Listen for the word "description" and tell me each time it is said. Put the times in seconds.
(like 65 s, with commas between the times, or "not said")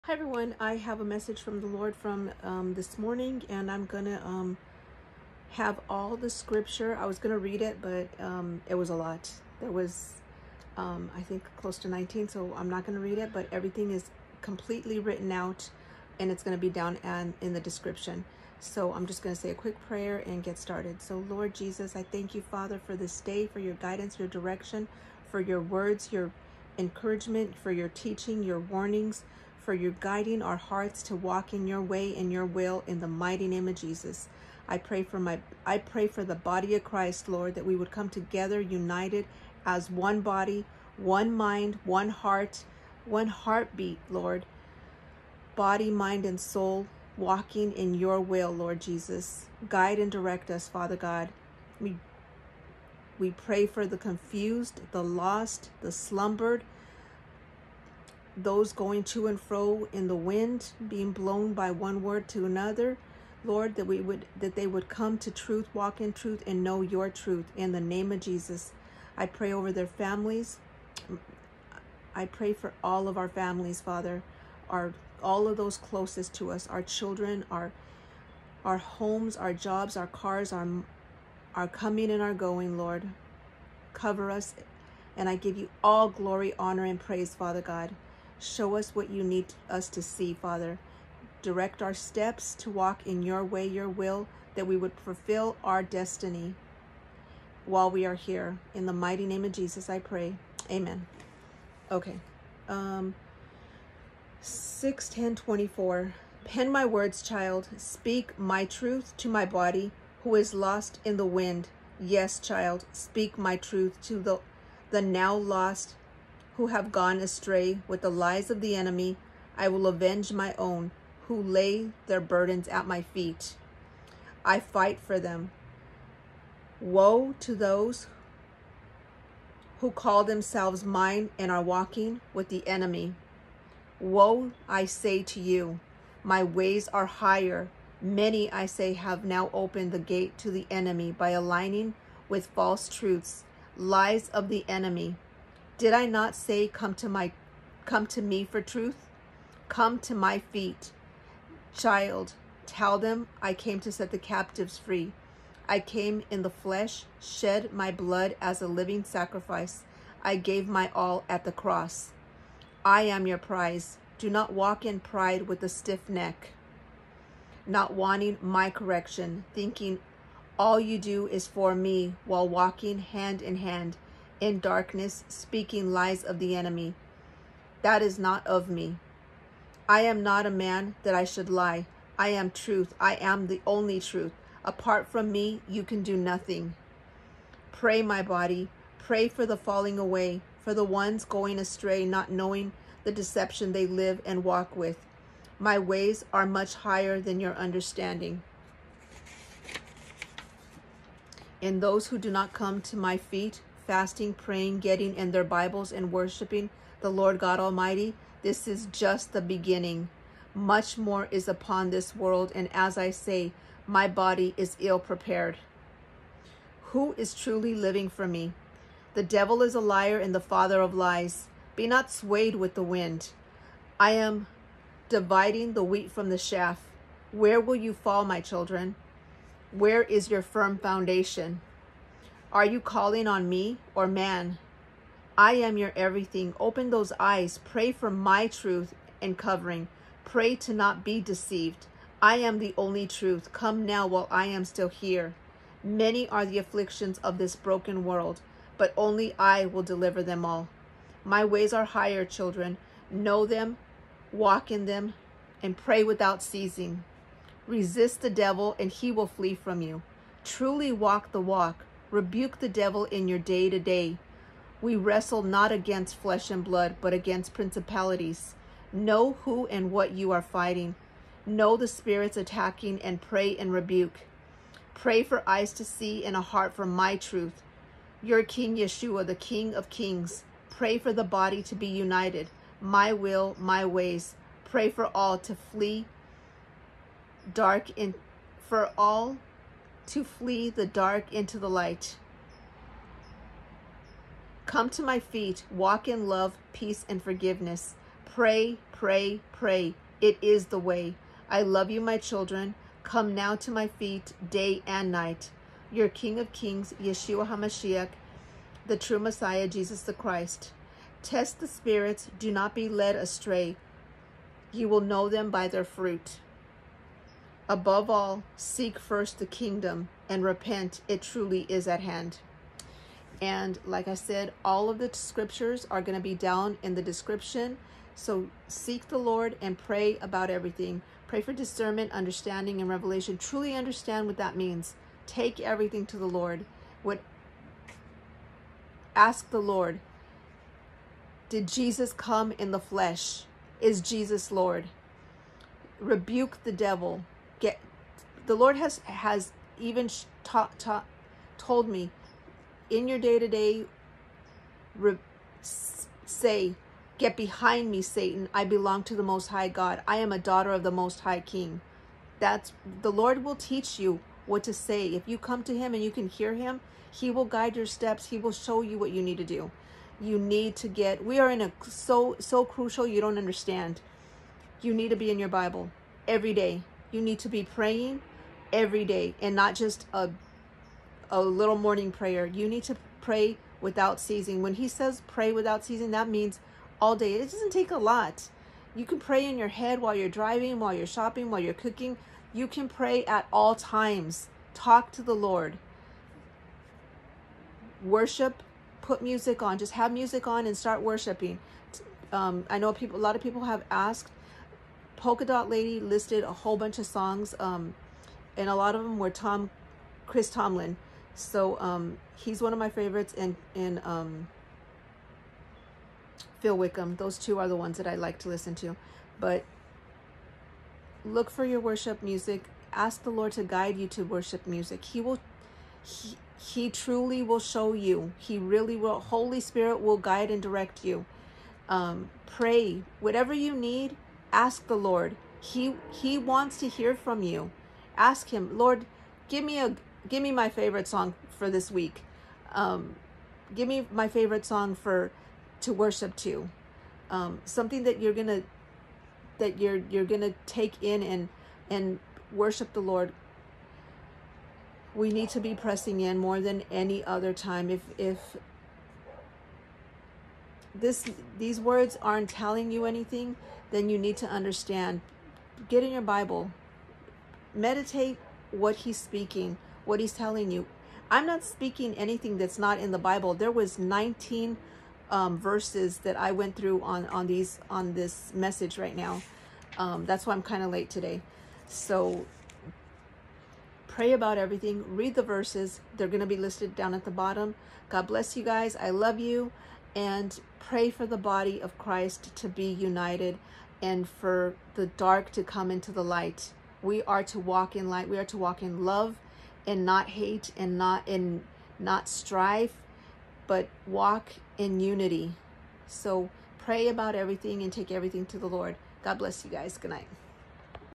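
17 s, 327 s.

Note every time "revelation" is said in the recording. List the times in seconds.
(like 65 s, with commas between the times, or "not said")
332 s.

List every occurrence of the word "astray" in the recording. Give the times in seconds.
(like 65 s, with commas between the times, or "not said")
117 s, 191 s, 313 s.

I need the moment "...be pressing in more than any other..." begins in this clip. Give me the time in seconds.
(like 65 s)
455 s.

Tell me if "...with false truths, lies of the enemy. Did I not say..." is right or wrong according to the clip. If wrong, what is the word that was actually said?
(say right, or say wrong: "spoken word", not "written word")
right.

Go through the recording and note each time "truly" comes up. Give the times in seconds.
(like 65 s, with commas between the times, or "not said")
217 s, 260 s, 321 s, 333 s, 426 s.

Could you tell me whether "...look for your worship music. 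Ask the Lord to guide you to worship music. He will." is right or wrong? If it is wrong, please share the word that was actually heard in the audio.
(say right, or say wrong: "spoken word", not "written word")
right.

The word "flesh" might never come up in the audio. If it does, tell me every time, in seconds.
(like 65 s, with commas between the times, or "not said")
156 s, 266 s, 342 s.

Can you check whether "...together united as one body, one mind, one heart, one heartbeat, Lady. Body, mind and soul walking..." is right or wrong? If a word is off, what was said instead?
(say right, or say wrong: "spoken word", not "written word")
wrong: "Lord", not "Lady".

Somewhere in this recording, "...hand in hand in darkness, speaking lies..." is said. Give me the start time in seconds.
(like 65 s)
172 s.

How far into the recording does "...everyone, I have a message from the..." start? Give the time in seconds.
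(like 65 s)
0 s.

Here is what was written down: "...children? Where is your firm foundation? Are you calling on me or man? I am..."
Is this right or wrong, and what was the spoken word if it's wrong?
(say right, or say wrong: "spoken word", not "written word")
right.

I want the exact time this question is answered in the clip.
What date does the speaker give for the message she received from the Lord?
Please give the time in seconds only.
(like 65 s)
104 s.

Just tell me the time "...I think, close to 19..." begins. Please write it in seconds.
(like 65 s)
11 s.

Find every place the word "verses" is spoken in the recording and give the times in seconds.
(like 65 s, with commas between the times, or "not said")
475 s, 485 s.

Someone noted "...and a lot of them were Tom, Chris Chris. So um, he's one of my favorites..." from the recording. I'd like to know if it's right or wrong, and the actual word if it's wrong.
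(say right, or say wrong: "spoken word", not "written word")
wrong: "Tomlin", not "Chris".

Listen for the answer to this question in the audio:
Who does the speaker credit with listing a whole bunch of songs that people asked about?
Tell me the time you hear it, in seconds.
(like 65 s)
405 s.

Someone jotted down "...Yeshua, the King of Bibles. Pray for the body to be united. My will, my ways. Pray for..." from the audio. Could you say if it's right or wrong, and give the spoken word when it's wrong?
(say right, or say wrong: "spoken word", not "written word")
wrong: "Kings", not "Bibles".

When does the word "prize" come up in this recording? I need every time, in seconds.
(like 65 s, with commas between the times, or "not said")
163 s.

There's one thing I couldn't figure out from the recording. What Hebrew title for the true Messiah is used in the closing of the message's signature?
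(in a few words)
Yeshua HaMashiach.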